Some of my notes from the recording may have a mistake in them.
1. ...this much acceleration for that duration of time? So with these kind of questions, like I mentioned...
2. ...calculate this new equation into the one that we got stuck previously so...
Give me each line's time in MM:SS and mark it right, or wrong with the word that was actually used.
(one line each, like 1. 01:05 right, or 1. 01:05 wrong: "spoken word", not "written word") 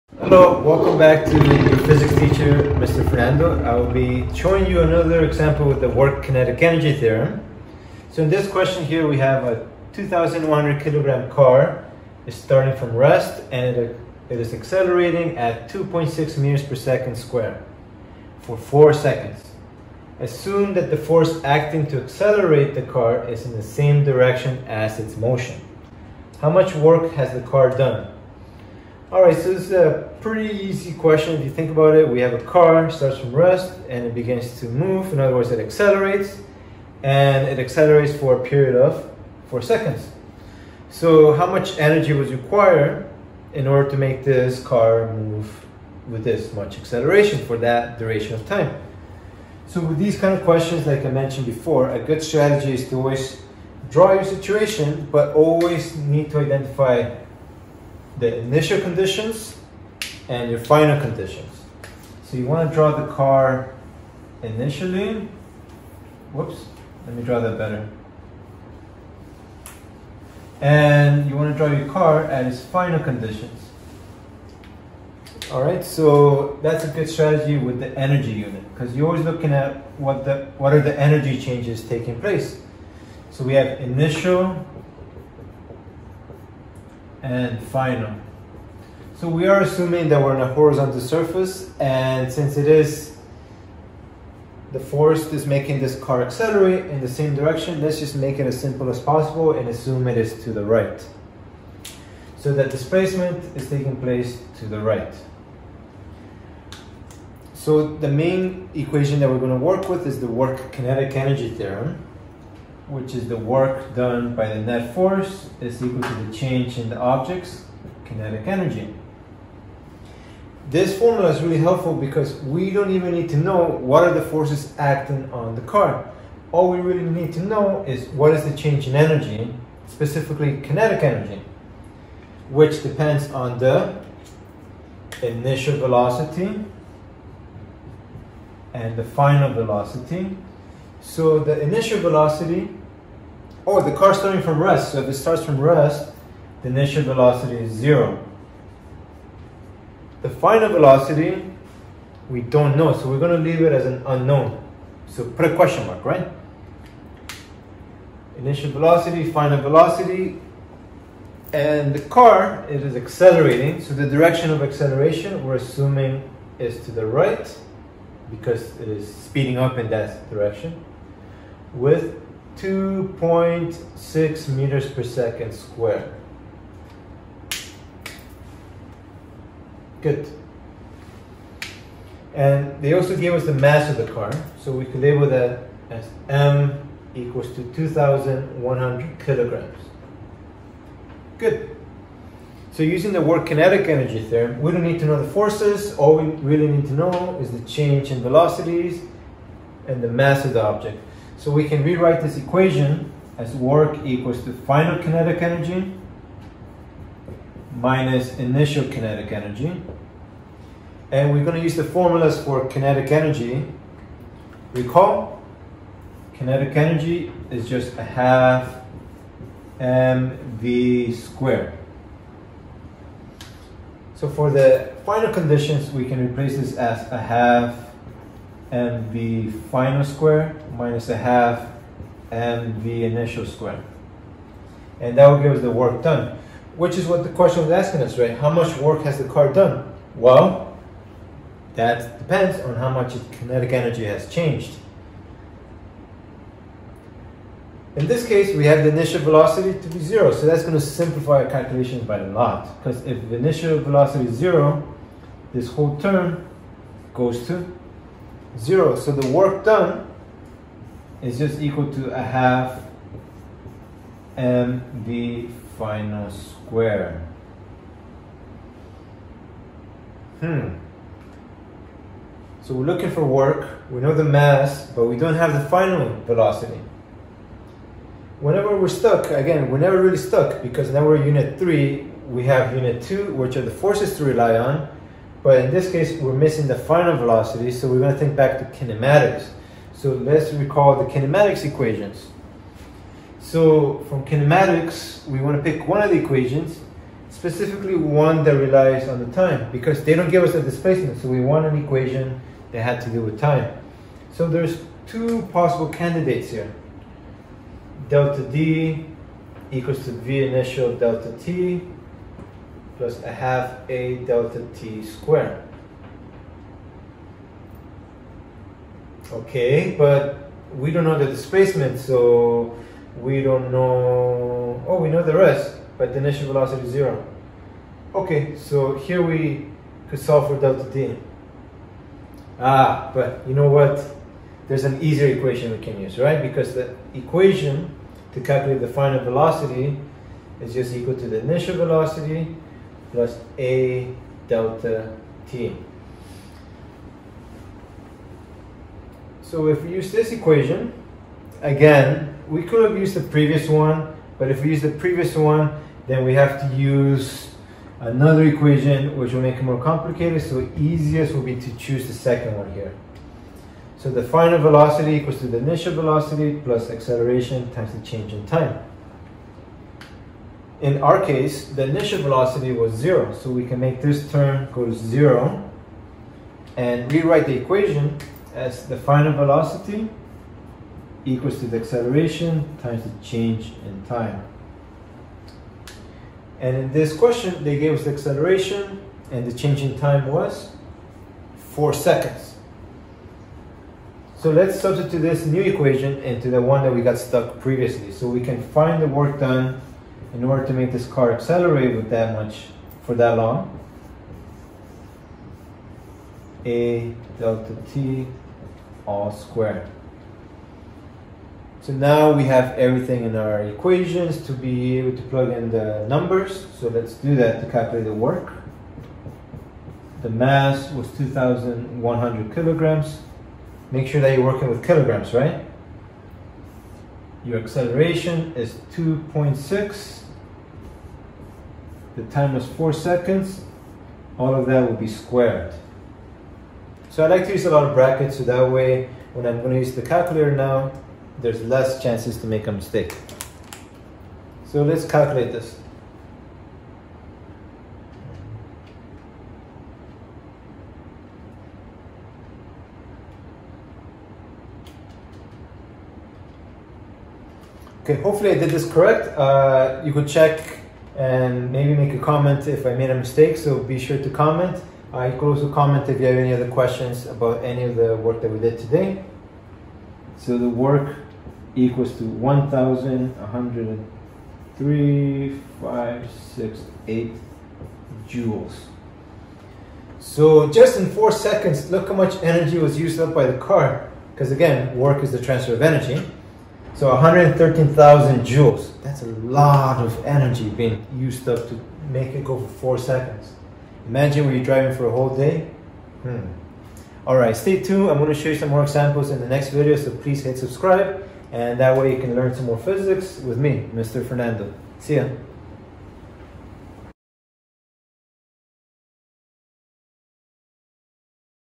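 1. 00:46 right
2. 06:34 wrong: "substitute", not "calculate".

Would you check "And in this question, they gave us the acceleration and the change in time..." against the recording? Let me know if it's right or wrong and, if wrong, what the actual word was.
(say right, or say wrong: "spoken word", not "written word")
right.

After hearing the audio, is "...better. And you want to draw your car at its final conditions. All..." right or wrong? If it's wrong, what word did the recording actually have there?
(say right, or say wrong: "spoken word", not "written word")
right.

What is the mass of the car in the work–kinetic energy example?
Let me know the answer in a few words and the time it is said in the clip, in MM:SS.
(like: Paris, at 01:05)
2,100 kg, at 00:09.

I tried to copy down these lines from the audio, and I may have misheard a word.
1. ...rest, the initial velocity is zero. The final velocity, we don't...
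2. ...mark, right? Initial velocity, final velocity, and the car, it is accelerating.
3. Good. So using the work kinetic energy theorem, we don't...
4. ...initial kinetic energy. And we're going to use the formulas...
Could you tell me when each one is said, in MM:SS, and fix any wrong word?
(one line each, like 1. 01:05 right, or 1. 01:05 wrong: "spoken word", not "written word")
1. 02:25 right
2. 02:35 right
3. 03:11 right
4. 03:28 right.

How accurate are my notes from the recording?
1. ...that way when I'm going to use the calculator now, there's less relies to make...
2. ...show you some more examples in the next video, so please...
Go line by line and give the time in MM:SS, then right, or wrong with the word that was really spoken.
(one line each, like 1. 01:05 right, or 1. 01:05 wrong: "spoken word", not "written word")
1. 07:18 wrong: "chances", not "relies"
2. 08:18 right.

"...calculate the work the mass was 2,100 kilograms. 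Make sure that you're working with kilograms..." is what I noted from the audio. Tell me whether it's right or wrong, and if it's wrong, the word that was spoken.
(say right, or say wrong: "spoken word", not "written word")
right.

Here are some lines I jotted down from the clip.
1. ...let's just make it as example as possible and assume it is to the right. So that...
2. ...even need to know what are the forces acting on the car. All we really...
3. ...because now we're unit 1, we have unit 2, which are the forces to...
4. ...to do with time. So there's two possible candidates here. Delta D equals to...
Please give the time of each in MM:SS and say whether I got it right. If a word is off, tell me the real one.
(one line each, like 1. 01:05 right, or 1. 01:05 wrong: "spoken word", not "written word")
1. 01:37 wrong: "simple", not "example"
2. 02:02 right
3. 04:40 wrong: "3", not "1"
4. 05:03 right.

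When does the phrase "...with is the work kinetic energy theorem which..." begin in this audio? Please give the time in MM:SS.
01:49.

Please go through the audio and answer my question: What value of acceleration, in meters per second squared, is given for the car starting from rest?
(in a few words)
2.6.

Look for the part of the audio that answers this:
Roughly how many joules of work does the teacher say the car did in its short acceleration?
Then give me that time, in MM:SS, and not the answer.
08:07.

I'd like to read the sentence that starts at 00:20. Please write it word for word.
Assume that the force acting to accelerate the car is in the same direction as its motion.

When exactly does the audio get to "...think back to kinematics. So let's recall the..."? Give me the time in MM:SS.
04:48.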